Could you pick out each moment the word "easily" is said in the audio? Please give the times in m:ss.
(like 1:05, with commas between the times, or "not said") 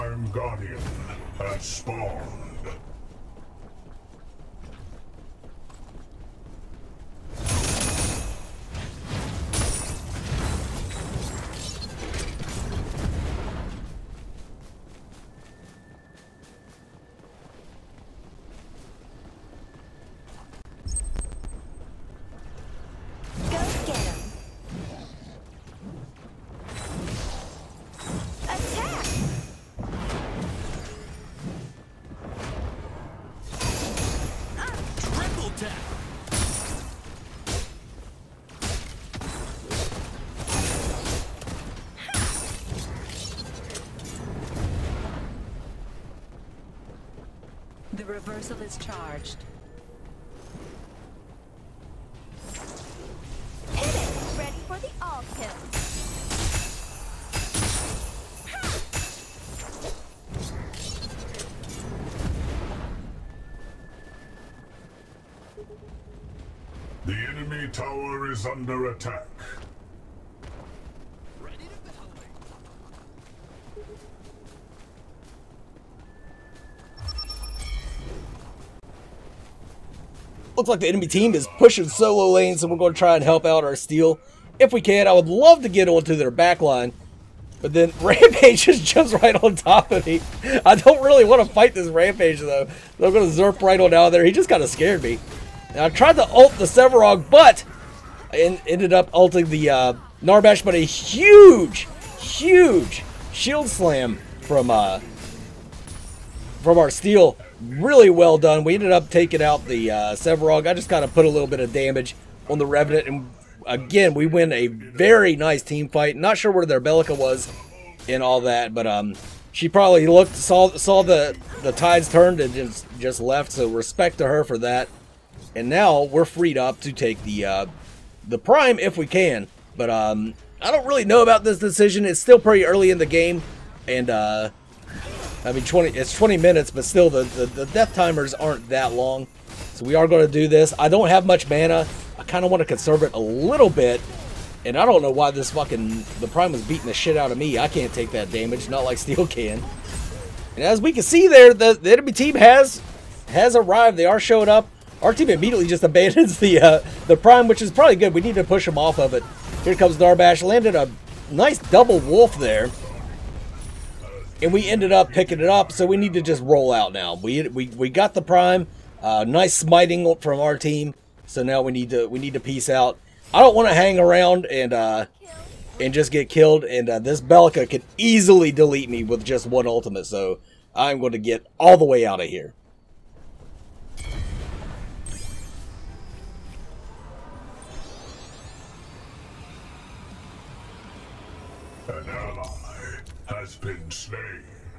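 2:57.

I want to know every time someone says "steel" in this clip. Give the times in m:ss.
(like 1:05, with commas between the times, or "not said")
1:23, 1:46, 2:28.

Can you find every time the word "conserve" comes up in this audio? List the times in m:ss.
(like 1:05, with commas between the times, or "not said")
2:22.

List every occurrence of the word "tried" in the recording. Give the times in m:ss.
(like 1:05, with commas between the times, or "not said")
1:35.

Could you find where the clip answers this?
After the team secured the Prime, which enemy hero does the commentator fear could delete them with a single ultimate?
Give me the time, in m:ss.
2:57.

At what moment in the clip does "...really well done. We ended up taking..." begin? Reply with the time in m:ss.
1:47.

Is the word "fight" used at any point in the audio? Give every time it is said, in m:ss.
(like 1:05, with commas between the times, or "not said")
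1:31, 1:55.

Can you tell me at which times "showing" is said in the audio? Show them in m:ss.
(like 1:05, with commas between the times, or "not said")
2:34.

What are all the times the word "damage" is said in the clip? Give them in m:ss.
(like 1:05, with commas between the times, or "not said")
1:51, 2:28.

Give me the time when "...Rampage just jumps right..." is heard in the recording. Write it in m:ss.
1:28.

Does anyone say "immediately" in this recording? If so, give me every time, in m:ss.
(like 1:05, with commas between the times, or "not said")
2:35.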